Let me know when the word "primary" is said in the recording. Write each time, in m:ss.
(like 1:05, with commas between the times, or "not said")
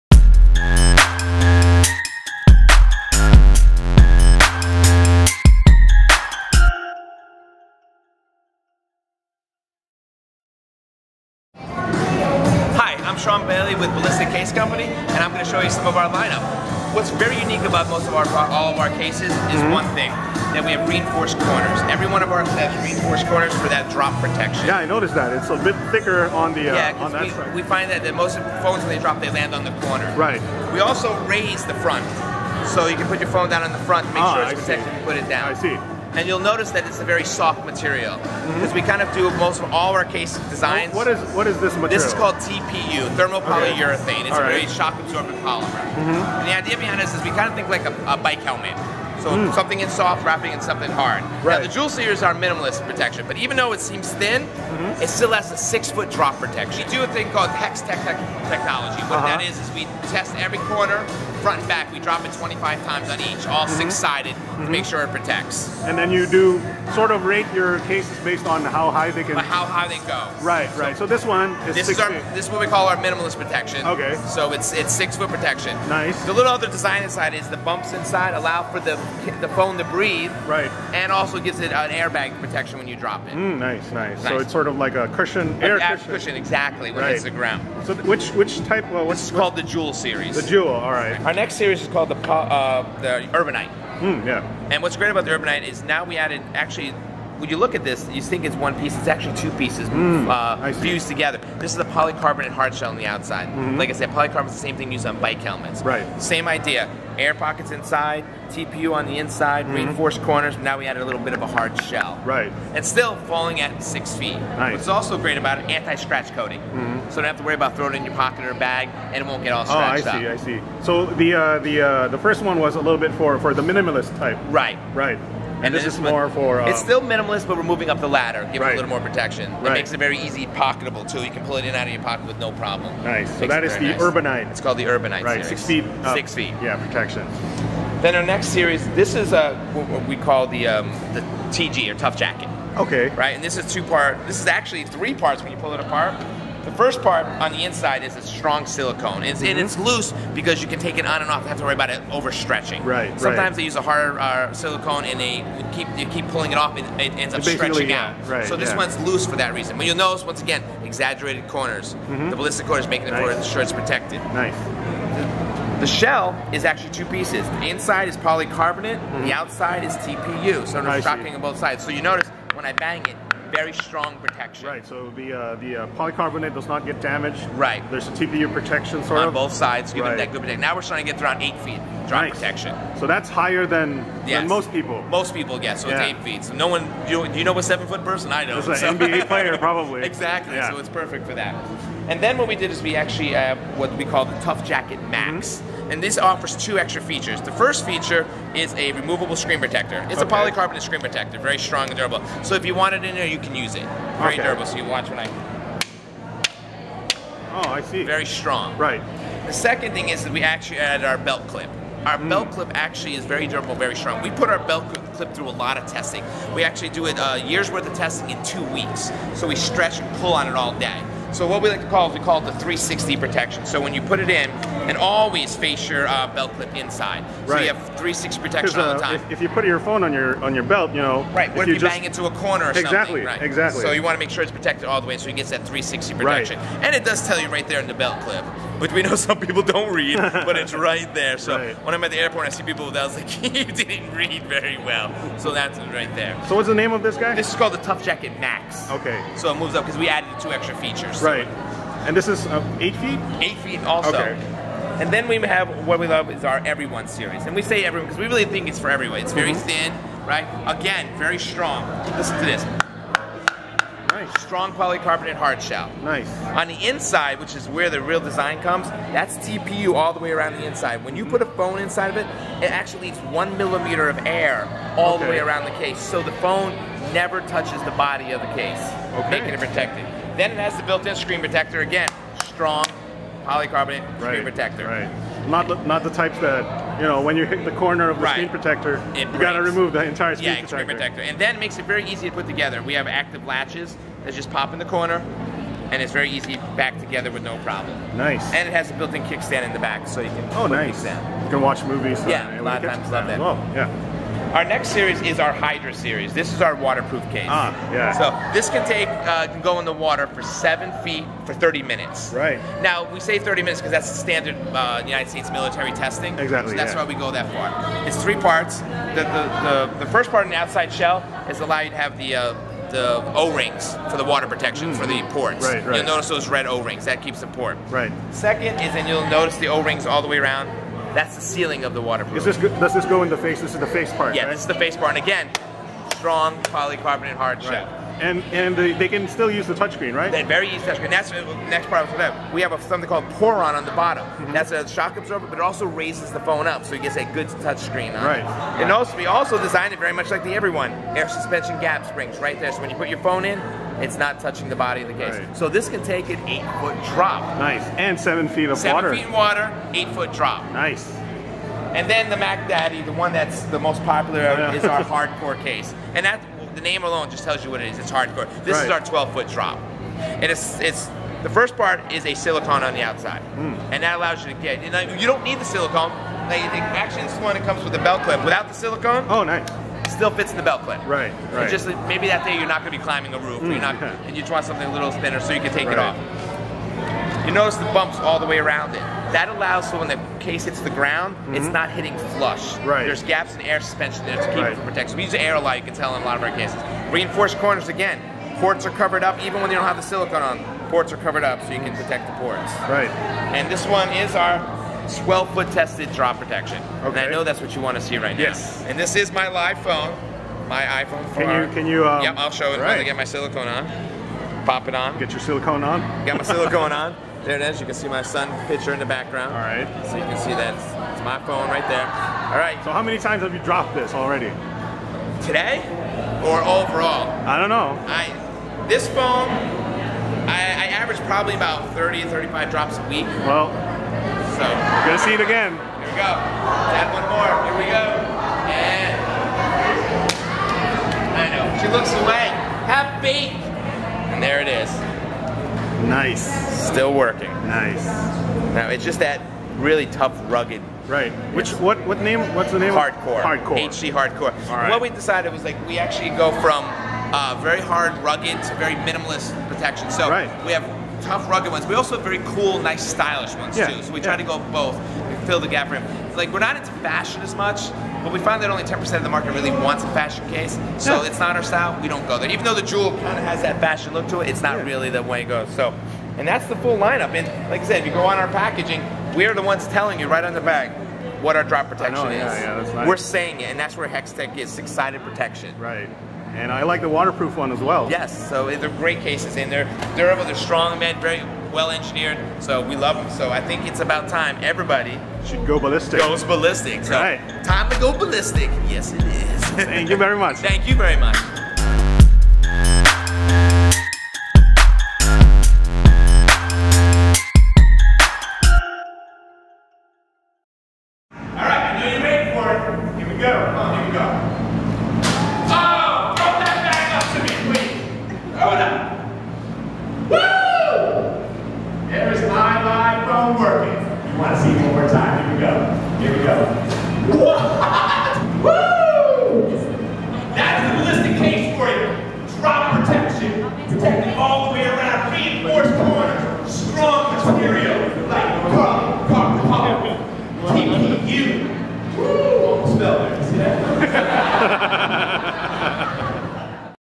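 not said.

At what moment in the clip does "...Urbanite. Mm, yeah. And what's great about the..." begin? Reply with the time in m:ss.
1:33.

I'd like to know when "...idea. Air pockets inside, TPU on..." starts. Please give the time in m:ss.
1:46.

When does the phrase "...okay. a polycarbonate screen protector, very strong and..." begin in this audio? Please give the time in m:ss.
3:20.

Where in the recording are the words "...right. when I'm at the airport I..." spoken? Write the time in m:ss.
4:01.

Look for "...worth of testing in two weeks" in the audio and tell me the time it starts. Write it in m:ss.
3:37.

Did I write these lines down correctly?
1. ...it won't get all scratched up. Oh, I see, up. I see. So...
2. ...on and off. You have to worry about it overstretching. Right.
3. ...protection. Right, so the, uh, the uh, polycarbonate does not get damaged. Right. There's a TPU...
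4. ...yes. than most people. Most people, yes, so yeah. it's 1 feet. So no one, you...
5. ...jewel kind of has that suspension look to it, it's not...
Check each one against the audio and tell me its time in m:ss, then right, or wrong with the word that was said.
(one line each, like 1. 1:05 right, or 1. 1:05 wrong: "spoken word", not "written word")
1. 1:59 right
2. 2:31 right
3. 2:54 right
4. 3:04 wrong: "8", not "1"
5. 7:52 wrong: "fashion", not "suspension".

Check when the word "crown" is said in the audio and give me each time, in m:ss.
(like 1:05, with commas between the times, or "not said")
not said.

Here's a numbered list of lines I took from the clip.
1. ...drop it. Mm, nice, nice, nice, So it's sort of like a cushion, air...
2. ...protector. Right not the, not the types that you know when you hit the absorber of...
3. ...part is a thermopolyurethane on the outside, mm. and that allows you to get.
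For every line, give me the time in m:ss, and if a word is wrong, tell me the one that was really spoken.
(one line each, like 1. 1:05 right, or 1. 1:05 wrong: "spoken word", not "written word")
1. 1:22 right
2. 4:44 wrong: "corner", not "absorber"
3. 6:11 wrong: "silicone", not "thermopolyurethane".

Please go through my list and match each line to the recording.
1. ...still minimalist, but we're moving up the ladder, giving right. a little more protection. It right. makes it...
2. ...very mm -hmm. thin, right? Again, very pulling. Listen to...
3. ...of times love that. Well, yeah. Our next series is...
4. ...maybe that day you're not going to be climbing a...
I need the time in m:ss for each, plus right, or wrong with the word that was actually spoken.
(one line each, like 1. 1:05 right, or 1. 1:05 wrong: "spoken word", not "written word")
1. 2:06 right
2. 4:19 wrong: "strong", not "pulling"
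3. 5:02 right
4. 6:22 right.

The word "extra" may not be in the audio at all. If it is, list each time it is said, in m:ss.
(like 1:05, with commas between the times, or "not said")
3:16, 4:10.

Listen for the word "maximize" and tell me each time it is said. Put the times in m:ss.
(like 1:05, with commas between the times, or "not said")
not said.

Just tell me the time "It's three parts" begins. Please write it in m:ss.
5:18.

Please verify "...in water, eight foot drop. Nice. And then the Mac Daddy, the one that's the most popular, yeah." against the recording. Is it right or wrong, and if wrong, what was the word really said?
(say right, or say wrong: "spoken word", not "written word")
right.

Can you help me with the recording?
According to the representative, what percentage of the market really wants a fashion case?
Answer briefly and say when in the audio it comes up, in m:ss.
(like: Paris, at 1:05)
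10%, at 7:48.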